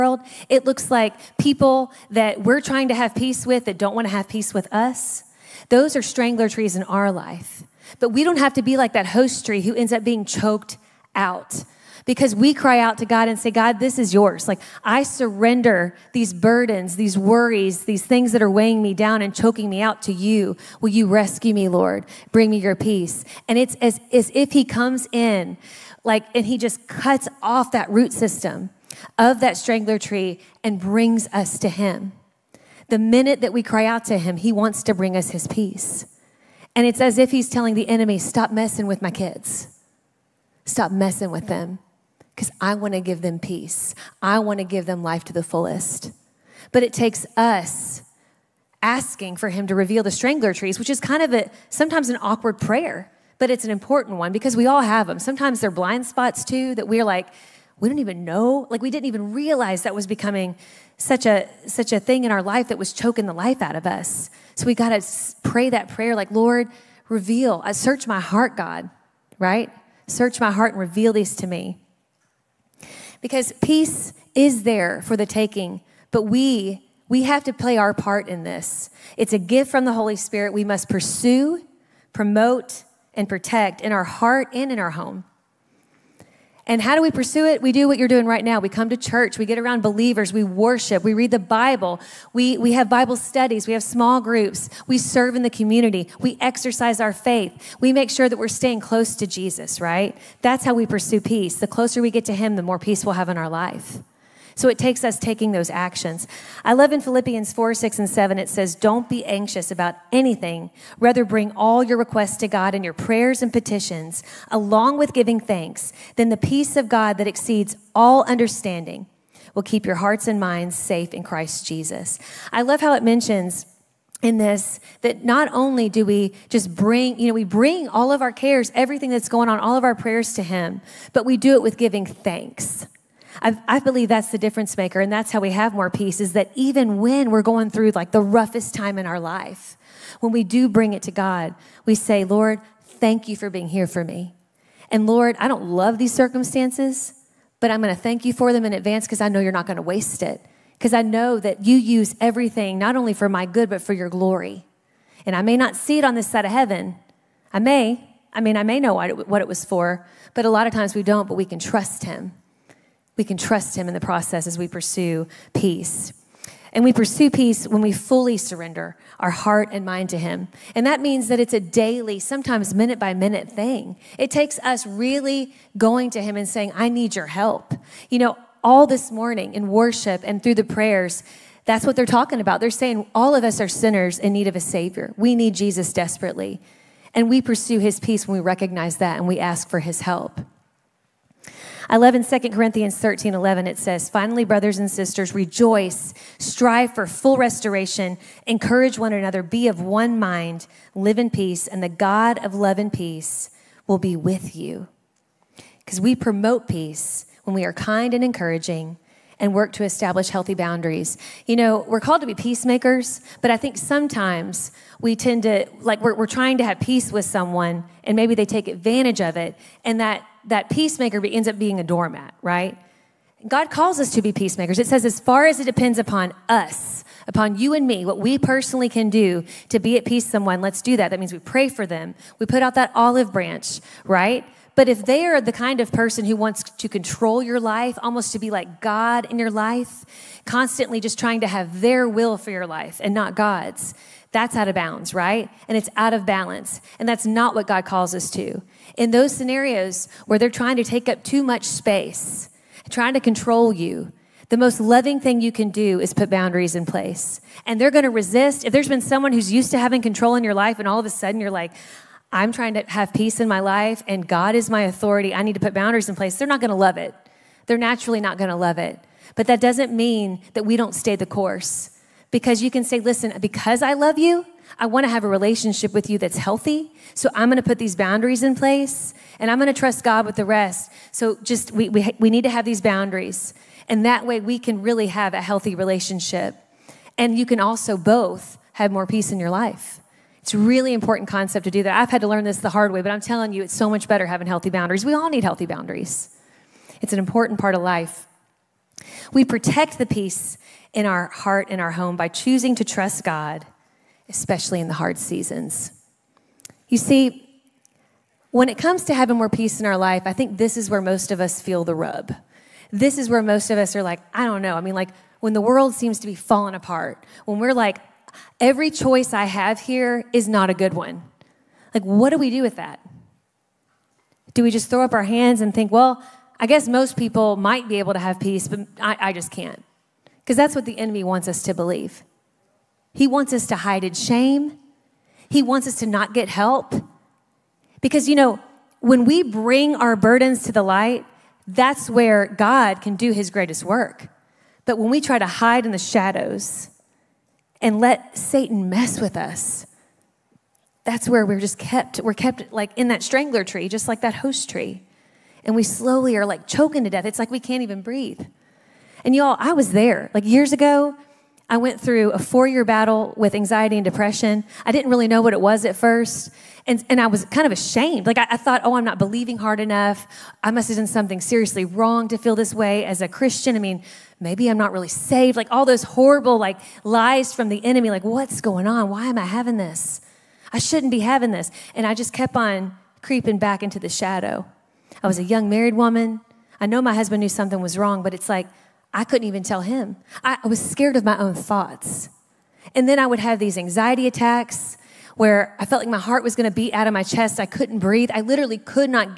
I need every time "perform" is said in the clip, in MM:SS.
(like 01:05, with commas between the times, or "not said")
not said.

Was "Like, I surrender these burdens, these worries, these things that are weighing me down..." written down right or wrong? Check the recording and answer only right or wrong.
right.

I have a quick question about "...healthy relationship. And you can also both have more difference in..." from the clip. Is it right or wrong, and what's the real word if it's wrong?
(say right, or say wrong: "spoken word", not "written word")
wrong: "peace", not "difference".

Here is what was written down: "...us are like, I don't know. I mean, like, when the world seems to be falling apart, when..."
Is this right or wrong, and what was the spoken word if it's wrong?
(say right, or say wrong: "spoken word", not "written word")
right.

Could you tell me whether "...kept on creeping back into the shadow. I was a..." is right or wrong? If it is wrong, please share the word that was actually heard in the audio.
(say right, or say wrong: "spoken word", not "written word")
right.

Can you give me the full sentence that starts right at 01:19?
It's a gift from the Holy Spirit we must pursue, promote, and protect in our heart and in our home.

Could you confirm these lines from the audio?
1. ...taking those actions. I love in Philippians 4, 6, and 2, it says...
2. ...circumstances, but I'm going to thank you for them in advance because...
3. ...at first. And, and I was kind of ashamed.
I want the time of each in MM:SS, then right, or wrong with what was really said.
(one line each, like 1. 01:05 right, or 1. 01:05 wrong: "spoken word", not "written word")
1. 01:45 wrong: "7", not "2"
2. 02:26 right
3. 06:05 right.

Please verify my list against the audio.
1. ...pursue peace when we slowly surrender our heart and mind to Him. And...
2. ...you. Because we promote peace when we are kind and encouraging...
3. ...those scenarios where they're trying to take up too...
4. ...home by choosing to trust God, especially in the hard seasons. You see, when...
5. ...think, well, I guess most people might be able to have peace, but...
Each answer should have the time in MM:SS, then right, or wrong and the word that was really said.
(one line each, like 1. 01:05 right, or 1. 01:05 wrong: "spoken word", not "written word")
1. 02:46 wrong: "fully", not "slowly"
2. 03:24 right
3. 04:09 right
4. 05:01 right
5. 05:25 right.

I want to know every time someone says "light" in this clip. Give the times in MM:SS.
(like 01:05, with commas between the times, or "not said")
05:40.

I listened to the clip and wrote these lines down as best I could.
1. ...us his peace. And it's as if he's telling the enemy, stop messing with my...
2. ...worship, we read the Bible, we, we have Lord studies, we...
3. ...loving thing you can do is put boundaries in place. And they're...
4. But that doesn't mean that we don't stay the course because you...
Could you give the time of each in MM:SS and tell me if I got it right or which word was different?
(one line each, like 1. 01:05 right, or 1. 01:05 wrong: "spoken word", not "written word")
1. 00:35 right
2. 01:30 wrong: "Bible", not "Lord"
3. 04:14 right
4. 04:29 right.